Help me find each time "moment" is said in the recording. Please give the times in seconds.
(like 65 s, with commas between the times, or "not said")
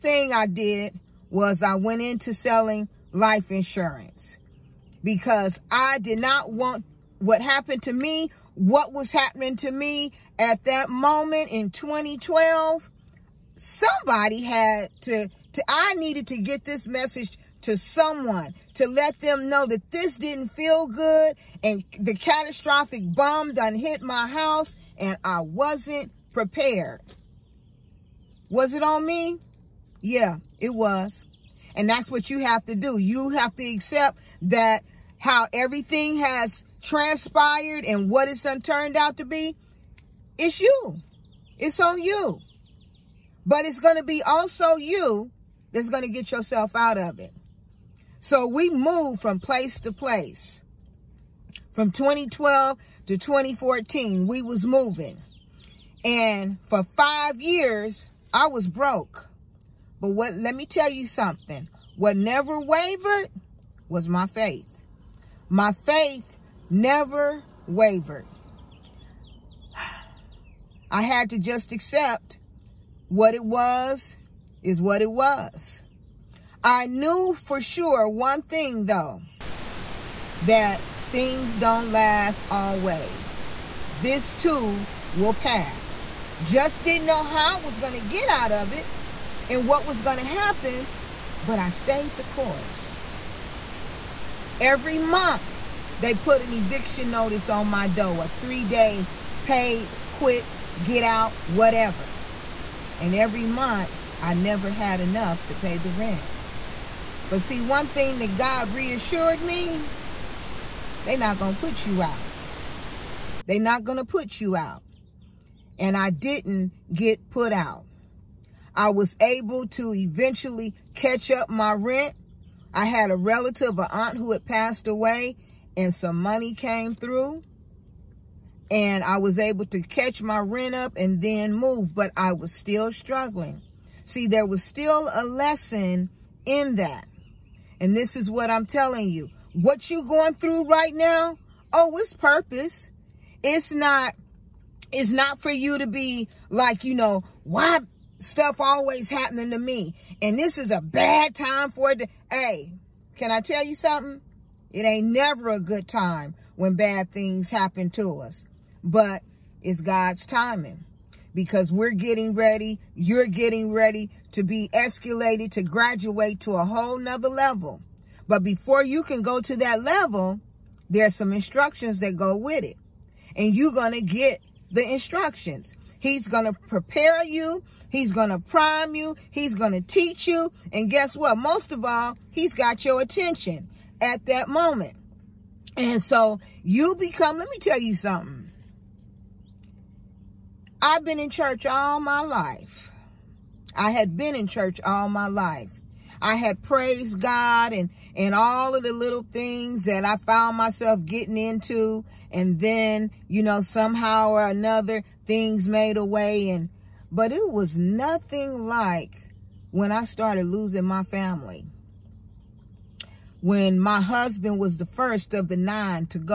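10 s, 184 s.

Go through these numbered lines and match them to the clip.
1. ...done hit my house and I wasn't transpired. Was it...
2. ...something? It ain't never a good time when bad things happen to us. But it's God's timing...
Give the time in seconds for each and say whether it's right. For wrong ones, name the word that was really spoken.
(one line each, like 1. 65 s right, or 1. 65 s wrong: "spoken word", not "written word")
1. 23 s wrong: "prepared", not "transpired"
2. 153 s right.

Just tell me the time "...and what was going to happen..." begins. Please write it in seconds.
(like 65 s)
89 s.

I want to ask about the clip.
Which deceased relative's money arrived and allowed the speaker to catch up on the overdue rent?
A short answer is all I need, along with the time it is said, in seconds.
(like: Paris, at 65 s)
An aunt, at 123 s.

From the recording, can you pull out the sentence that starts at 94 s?
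Every month, they put an eviction notice on my door, a three-day pay, quit, get out, whatever.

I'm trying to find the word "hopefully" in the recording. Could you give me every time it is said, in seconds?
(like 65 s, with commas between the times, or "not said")
not said.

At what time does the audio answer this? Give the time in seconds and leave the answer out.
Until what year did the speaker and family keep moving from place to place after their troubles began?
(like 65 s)
53 s.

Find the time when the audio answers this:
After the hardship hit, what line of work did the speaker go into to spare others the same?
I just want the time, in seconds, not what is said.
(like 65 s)
2 s.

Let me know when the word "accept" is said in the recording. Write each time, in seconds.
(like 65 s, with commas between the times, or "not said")
33 s, 71 s.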